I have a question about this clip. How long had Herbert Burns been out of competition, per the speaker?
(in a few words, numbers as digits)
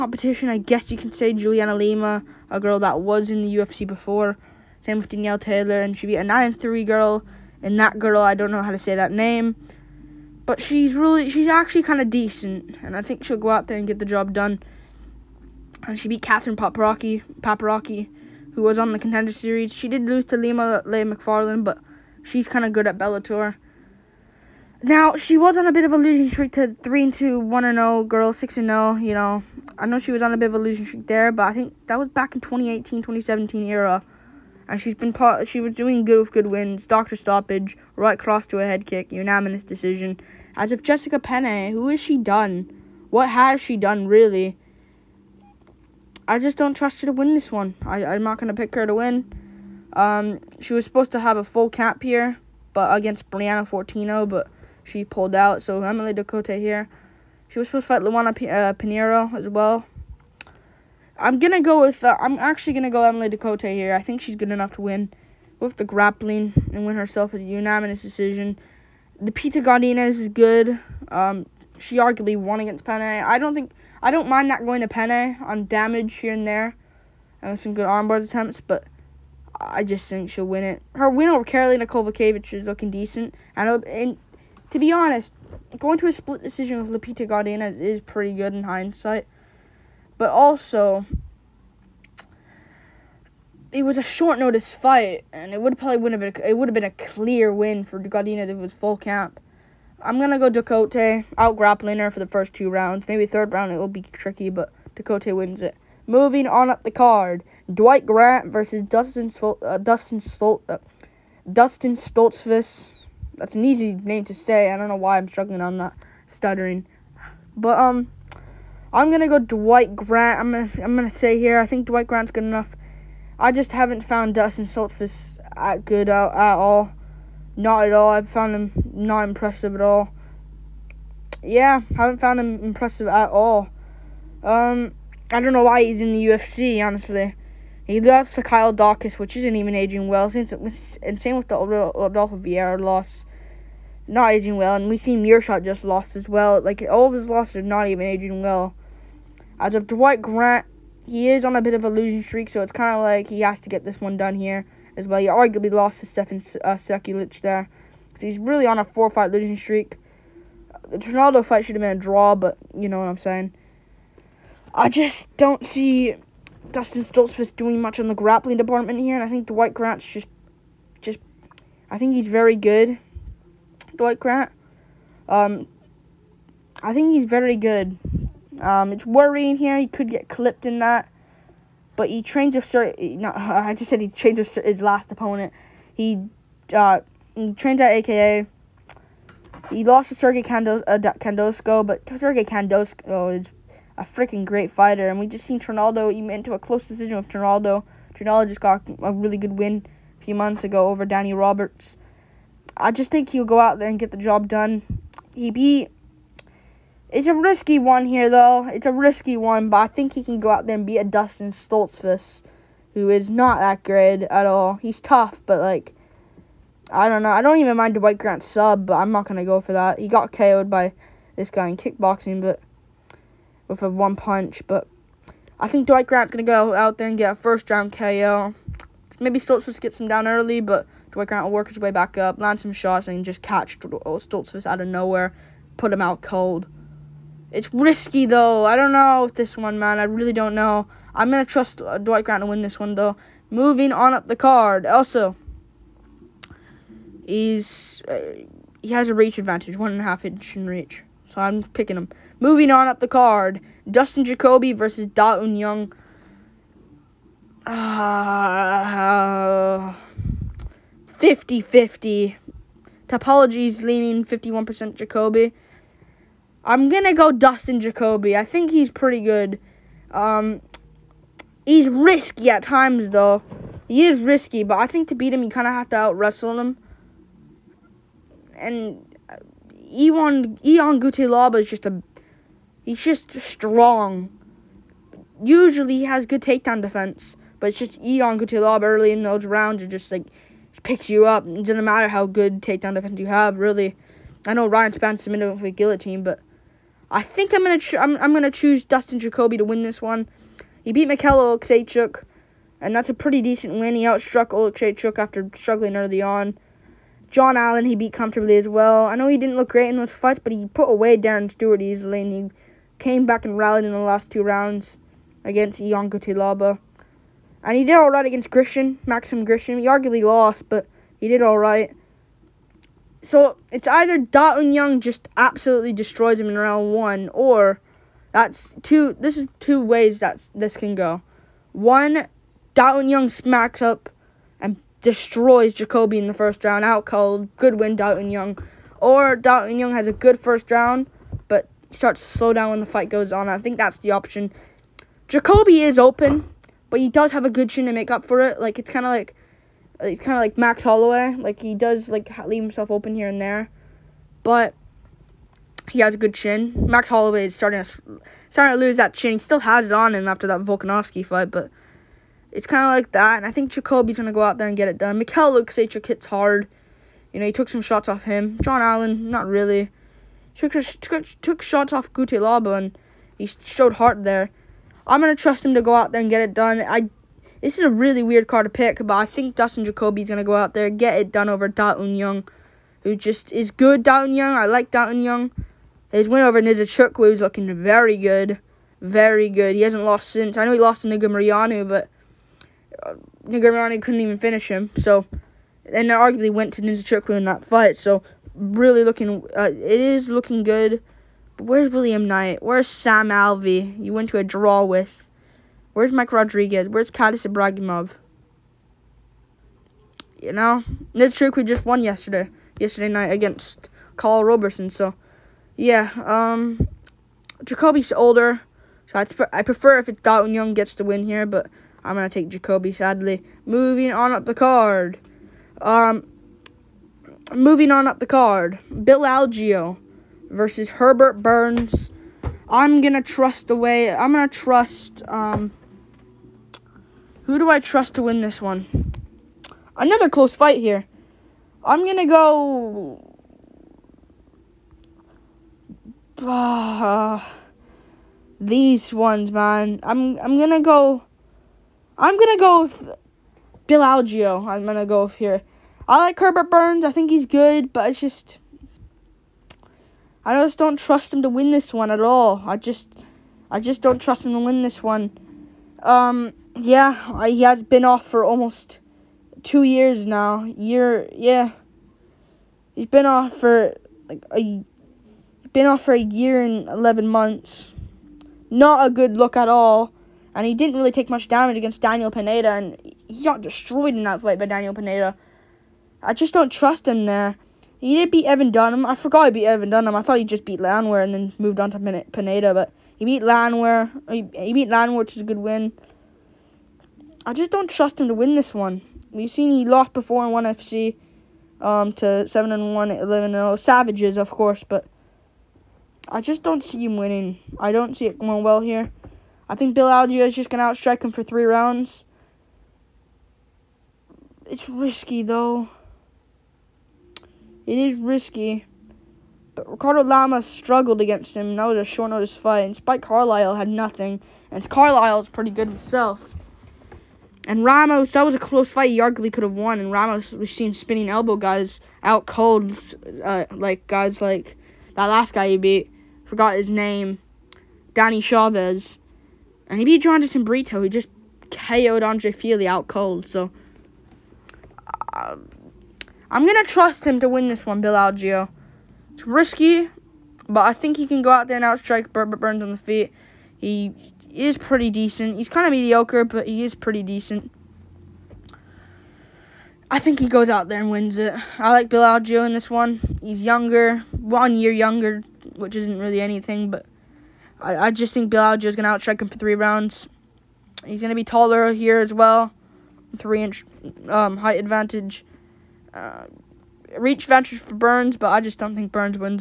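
a year and 11 months.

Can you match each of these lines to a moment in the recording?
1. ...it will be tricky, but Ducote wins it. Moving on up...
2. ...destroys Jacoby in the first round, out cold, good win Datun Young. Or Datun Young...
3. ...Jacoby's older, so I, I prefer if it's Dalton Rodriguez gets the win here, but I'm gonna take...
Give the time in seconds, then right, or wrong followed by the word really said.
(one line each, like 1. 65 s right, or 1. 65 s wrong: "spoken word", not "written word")
1. 103 s right
2. 335 s right
3. 417 s wrong: "Young", not "Rodriguez".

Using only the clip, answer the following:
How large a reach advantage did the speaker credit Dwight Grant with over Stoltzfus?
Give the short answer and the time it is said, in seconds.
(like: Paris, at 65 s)
one and a half inch, at 249 s.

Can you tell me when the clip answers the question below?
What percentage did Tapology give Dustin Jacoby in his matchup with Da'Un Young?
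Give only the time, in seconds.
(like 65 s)
264 s.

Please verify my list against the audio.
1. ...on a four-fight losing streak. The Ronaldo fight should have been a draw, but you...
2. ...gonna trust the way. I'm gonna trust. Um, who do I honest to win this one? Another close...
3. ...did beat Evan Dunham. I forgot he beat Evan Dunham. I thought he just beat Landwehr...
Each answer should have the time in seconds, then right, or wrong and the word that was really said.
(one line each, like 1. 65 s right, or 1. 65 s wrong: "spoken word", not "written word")
1. 158 s right
2. 433 s wrong: "trust", not "honest"
3. 488 s right.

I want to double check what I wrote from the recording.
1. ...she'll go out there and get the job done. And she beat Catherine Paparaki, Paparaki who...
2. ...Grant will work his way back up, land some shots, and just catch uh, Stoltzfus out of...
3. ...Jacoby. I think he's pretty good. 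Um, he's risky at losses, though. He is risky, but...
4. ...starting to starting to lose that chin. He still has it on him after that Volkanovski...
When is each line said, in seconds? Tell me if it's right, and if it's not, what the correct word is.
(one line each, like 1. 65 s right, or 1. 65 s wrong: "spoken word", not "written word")
1. 13 s right
2. 231 s right
3. 267 s wrong: "times", not "losses"
4. 357 s right.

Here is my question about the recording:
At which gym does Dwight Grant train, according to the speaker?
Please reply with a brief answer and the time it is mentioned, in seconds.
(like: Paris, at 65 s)
AKA, at 187 s.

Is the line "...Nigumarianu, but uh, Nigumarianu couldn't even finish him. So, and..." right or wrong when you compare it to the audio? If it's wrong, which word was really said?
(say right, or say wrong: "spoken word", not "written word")
right.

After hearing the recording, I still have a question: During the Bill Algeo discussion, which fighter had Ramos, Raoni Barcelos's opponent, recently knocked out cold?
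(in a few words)
Andre Fili.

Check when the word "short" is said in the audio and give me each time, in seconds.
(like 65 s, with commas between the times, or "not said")
94 s, 522 s.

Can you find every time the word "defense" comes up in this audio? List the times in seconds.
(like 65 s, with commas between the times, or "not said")
286 s, 292 s.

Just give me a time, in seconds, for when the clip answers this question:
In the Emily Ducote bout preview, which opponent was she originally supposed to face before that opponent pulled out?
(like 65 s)
53 s.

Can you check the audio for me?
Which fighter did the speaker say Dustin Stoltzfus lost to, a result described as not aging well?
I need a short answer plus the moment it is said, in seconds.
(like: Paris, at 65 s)
Kyle Daukaus, at 138 s.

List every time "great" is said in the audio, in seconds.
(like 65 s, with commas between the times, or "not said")
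194 s, 213 s, 309 s.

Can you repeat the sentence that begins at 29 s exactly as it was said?
I know she was on a bit of a losing streak there, but I think that was back in 2018, 2017 era.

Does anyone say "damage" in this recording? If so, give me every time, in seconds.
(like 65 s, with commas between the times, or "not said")
75 s, 481 s.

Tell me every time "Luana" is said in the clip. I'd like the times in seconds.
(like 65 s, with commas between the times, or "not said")
58 s.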